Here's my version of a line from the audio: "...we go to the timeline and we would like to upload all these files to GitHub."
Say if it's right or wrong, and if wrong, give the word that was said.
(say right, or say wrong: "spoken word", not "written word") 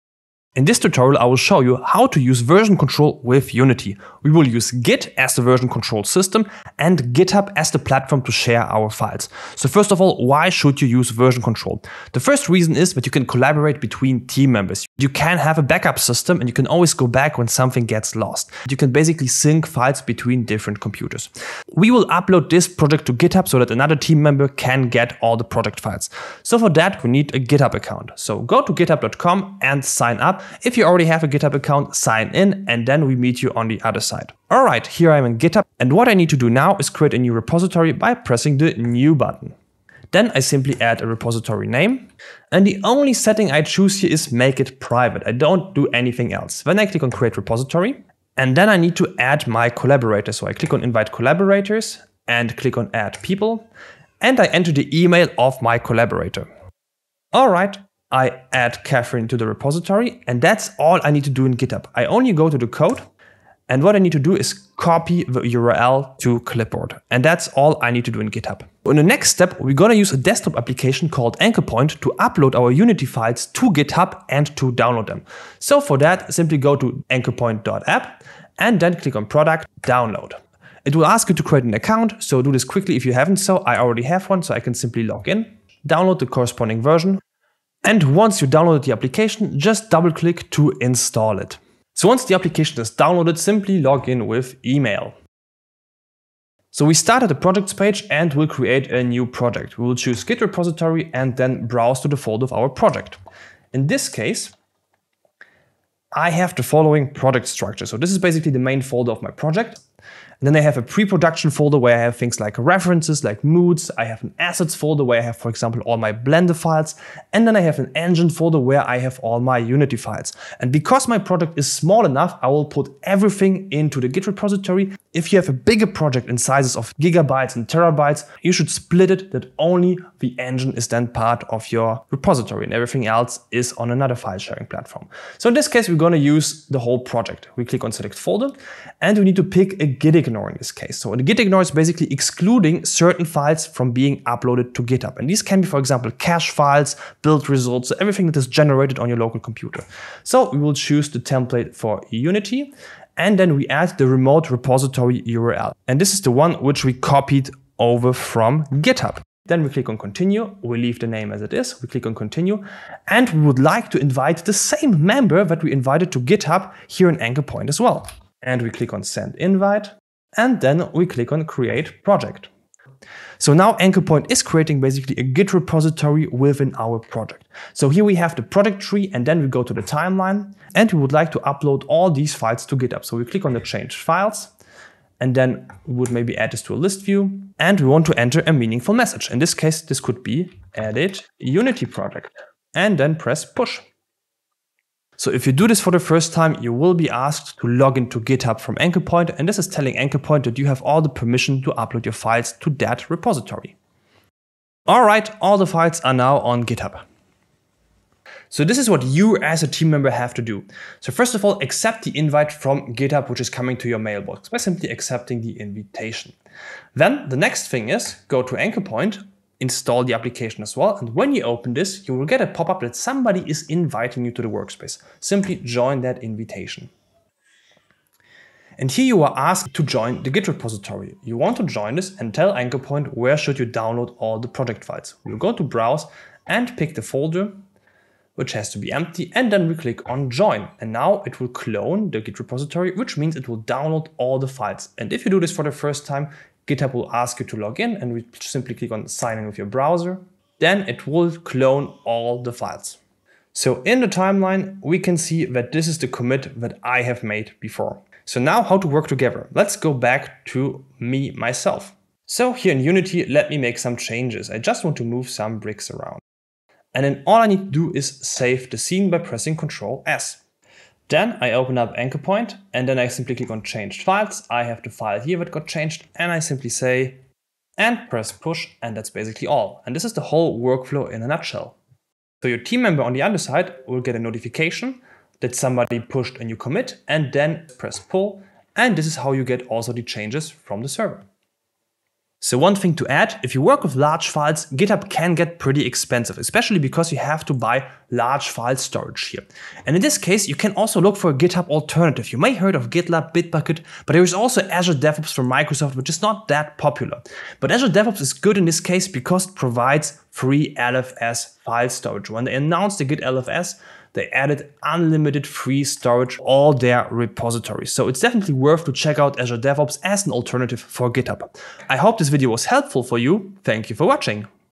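right.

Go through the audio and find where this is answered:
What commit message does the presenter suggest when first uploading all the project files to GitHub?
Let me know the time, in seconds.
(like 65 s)
190 s.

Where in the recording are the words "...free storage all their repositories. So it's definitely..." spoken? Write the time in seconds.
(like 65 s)
315 s.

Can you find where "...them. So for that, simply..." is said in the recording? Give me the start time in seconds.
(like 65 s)
75 s.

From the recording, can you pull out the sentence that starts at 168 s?
And we click on send invite, and then we click on create project.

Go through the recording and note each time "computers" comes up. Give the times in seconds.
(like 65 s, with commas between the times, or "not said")
20 s, 149 s.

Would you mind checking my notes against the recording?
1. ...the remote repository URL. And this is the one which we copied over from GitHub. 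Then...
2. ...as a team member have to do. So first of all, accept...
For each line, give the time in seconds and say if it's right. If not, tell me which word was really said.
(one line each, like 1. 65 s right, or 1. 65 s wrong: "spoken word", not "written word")
1. 153 s right
2. 209 s right.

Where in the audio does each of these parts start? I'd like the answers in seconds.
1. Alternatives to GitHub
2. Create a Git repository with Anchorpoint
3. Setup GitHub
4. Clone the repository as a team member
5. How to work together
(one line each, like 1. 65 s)
1. 291 s
2. 75 s
3. 26 s
4. 208 s
5. 262 s.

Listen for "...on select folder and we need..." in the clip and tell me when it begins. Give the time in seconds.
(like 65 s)
137 s.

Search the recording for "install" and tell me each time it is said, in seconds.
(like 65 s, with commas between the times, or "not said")
90 s, 219 s.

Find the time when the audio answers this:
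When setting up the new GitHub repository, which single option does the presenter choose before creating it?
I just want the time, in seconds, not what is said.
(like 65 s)
44 s.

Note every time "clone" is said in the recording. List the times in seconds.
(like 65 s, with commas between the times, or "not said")
241 s, 251 s.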